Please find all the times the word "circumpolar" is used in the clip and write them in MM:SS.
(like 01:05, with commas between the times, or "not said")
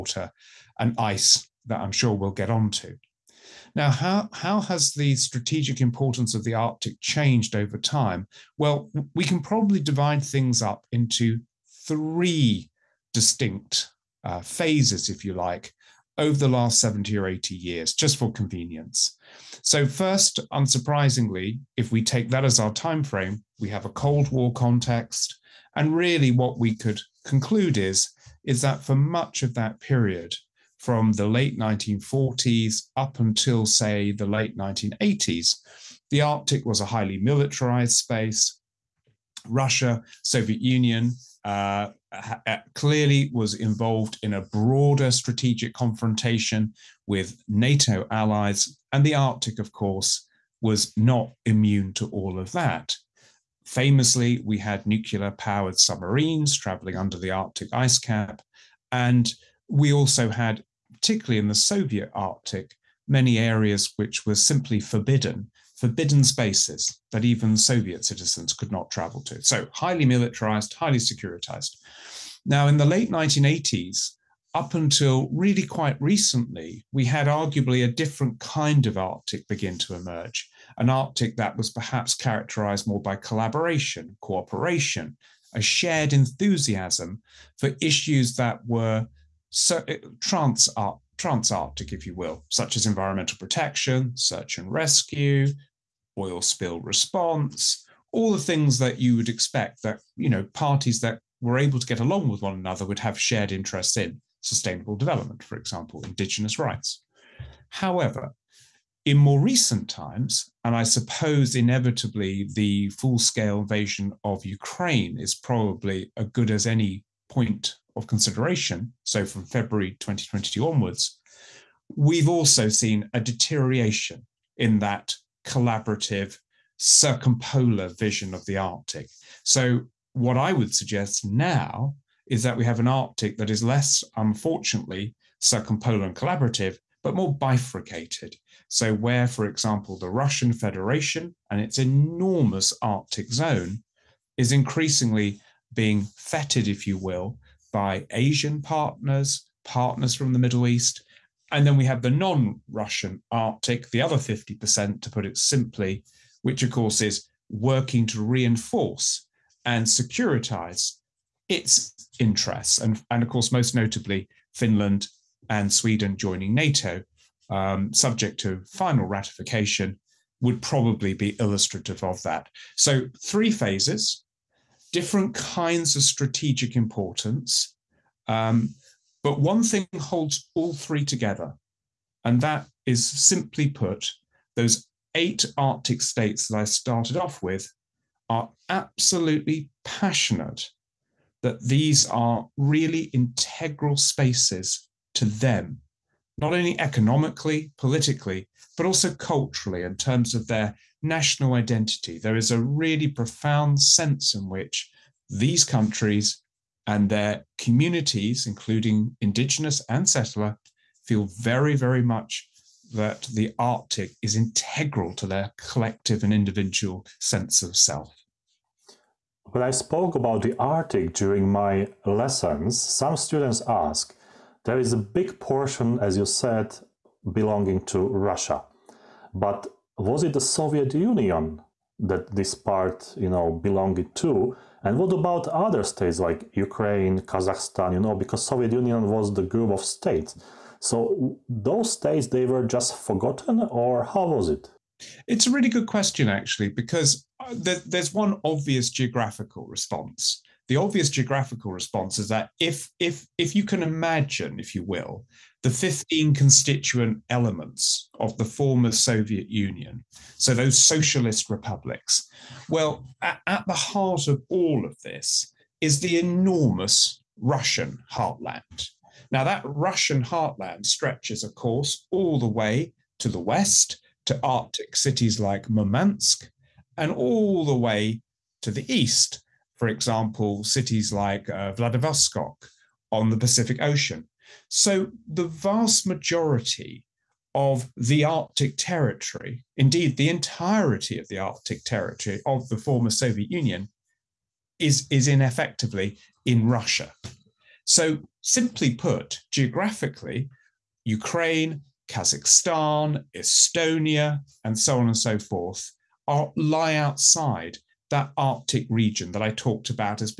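02:06, 02:15.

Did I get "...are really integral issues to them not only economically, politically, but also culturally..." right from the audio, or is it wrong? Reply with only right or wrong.
wrong.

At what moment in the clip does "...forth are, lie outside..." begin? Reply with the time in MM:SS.
05:05.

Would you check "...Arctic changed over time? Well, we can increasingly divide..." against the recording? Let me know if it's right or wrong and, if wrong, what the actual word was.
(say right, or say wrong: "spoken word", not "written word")
wrong: "probably", not "increasingly".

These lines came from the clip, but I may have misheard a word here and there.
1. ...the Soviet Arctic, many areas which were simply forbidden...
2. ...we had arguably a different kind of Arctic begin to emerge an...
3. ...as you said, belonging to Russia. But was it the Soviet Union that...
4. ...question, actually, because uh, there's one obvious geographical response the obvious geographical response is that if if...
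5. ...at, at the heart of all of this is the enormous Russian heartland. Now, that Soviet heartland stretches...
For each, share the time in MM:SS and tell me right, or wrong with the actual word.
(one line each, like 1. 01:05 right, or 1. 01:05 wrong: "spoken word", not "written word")
1. 01:01 right
2. 01:16 right
3. 03:45 right
4. 04:05 right
5. 04:23 wrong: "Russian", not "Soviet".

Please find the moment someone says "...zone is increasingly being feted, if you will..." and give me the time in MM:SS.
02:23.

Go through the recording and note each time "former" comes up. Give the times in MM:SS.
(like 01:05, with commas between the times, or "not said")
04:18, 04:52.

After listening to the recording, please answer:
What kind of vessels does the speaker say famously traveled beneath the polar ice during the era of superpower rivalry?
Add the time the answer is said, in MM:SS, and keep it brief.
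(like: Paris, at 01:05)
Nuclear powered submarines, at 00:54.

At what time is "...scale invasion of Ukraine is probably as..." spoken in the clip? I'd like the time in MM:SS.
01:53.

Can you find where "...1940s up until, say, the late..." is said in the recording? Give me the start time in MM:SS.
00:31.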